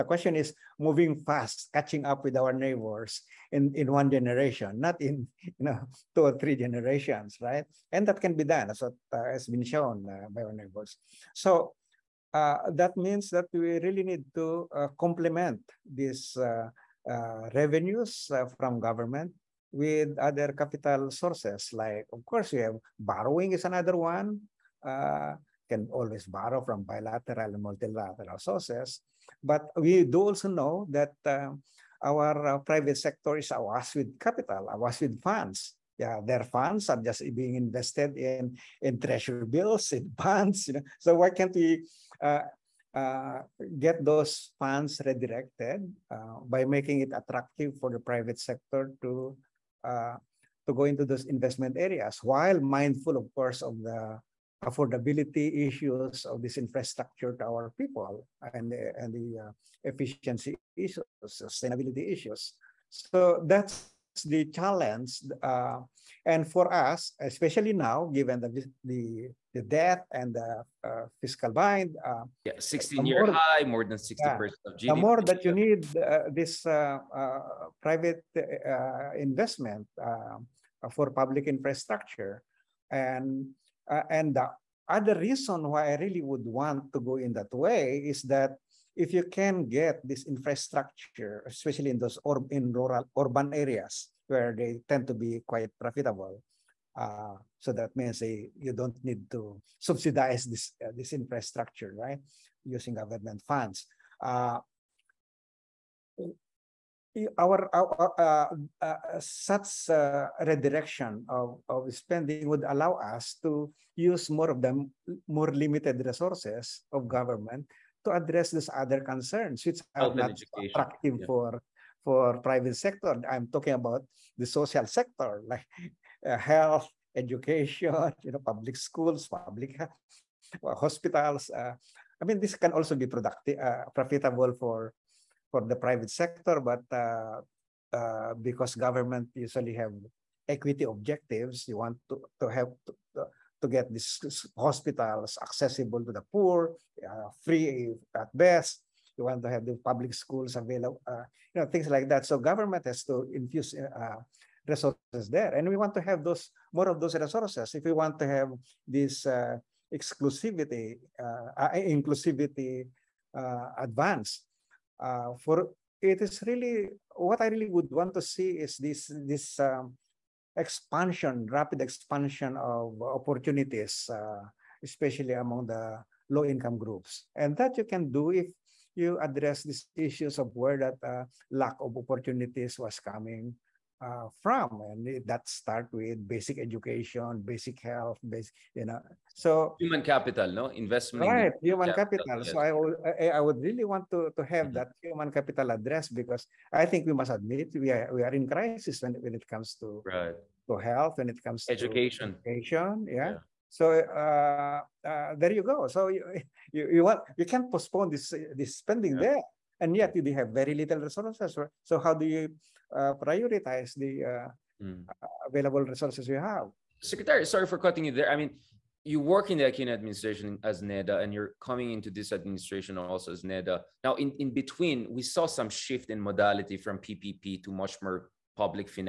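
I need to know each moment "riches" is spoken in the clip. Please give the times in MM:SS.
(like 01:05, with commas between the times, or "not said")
not said.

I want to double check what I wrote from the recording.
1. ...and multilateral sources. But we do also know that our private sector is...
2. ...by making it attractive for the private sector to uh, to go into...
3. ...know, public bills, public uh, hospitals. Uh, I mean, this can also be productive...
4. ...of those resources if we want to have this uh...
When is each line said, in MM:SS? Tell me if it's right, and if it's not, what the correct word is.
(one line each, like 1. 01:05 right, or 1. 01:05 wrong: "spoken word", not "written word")
1. 00:27 right
2. 00:46 right
3. 02:08 wrong: "schools", not "bills"
4. 02:36 right.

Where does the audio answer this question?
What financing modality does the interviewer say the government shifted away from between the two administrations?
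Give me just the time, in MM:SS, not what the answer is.
03:46.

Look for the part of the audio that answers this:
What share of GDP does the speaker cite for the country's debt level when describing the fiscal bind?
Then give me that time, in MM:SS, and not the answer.
01:13.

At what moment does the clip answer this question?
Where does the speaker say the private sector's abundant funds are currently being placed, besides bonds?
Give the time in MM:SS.
00:38.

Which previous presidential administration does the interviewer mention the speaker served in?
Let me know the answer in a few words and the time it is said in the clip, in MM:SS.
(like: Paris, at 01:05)
Aquino administration, at 03:39.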